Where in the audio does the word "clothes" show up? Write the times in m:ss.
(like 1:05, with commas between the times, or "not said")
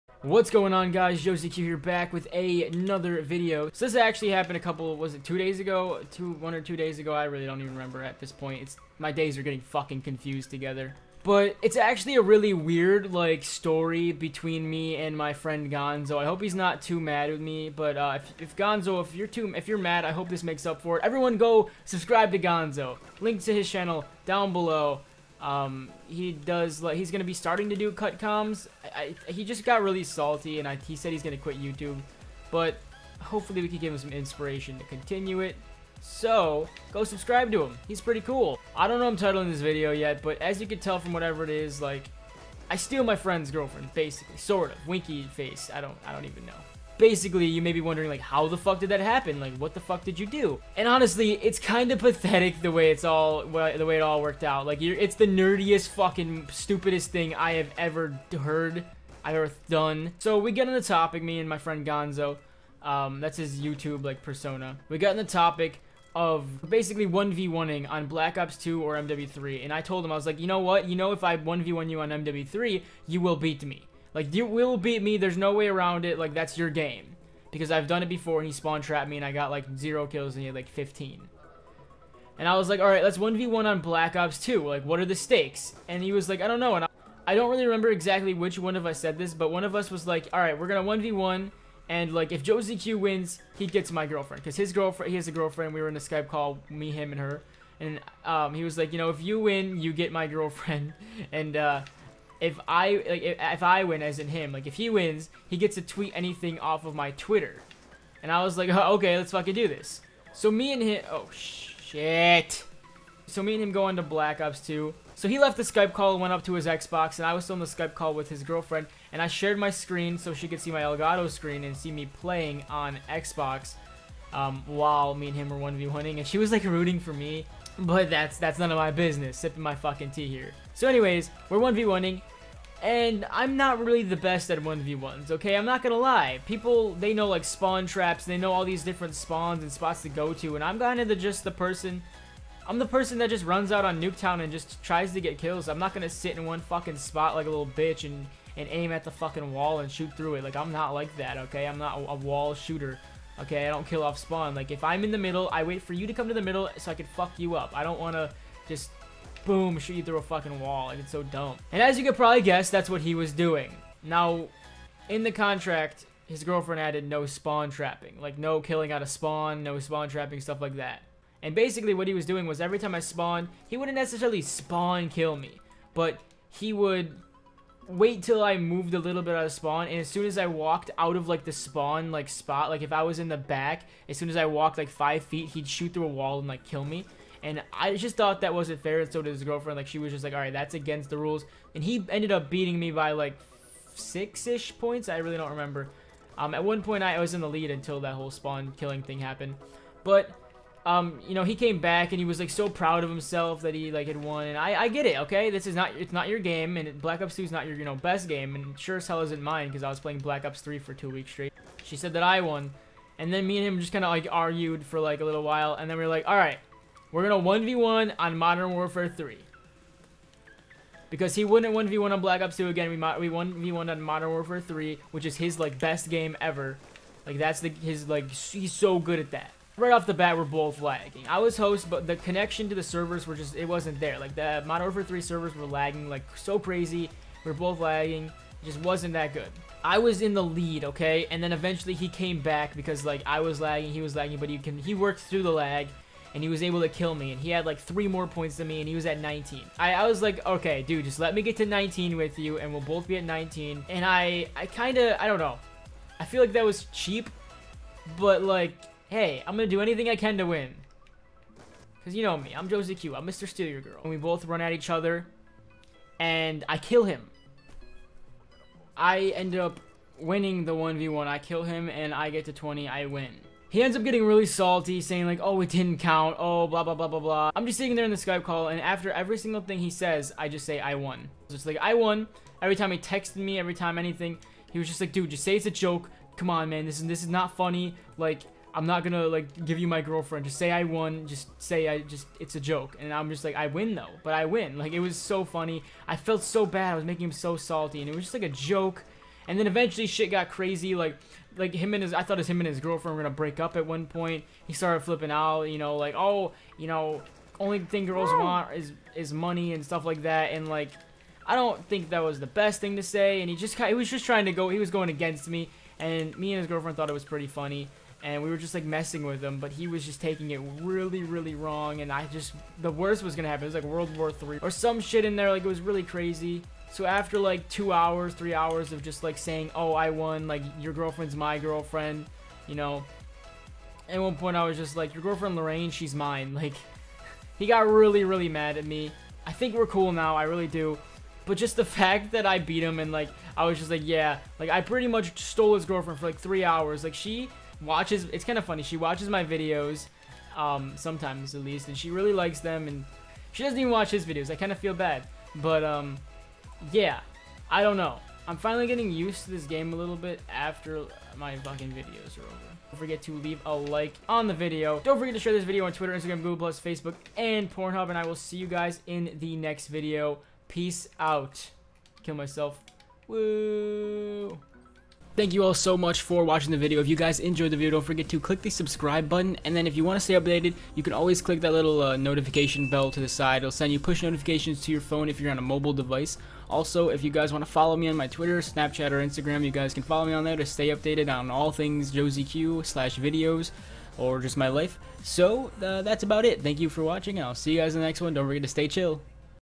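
not said.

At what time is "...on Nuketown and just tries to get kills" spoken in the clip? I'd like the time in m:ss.
2:23.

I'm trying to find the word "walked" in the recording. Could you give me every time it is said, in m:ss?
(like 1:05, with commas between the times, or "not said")
3:00, 3:04.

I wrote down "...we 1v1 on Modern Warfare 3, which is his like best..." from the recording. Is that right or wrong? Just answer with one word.
right.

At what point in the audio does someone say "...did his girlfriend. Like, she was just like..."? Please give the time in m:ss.
3:09.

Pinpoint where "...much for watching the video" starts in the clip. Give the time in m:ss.
6:15.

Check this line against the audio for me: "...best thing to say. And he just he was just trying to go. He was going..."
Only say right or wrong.
right.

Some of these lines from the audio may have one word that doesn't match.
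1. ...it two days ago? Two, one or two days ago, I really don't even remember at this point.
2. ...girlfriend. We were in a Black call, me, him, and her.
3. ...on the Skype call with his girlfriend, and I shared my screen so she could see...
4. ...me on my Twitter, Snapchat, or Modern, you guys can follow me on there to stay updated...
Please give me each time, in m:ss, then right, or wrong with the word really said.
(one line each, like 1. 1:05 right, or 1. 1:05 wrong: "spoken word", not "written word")
1. 0:05 right
2. 1:35 wrong: "Skype", not "Black"
3. 1:57 right
4. 6:27 wrong: "Instagram", not "Modern".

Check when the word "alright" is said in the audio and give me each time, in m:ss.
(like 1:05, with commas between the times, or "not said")
1:22, 1:30.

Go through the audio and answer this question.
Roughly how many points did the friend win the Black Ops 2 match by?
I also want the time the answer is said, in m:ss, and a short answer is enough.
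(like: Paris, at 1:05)
About 6, at 3:13.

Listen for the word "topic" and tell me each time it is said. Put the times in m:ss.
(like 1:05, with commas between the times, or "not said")
1:00, 1:05.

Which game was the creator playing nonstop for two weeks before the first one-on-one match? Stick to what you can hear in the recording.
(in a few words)
Black Ops 3.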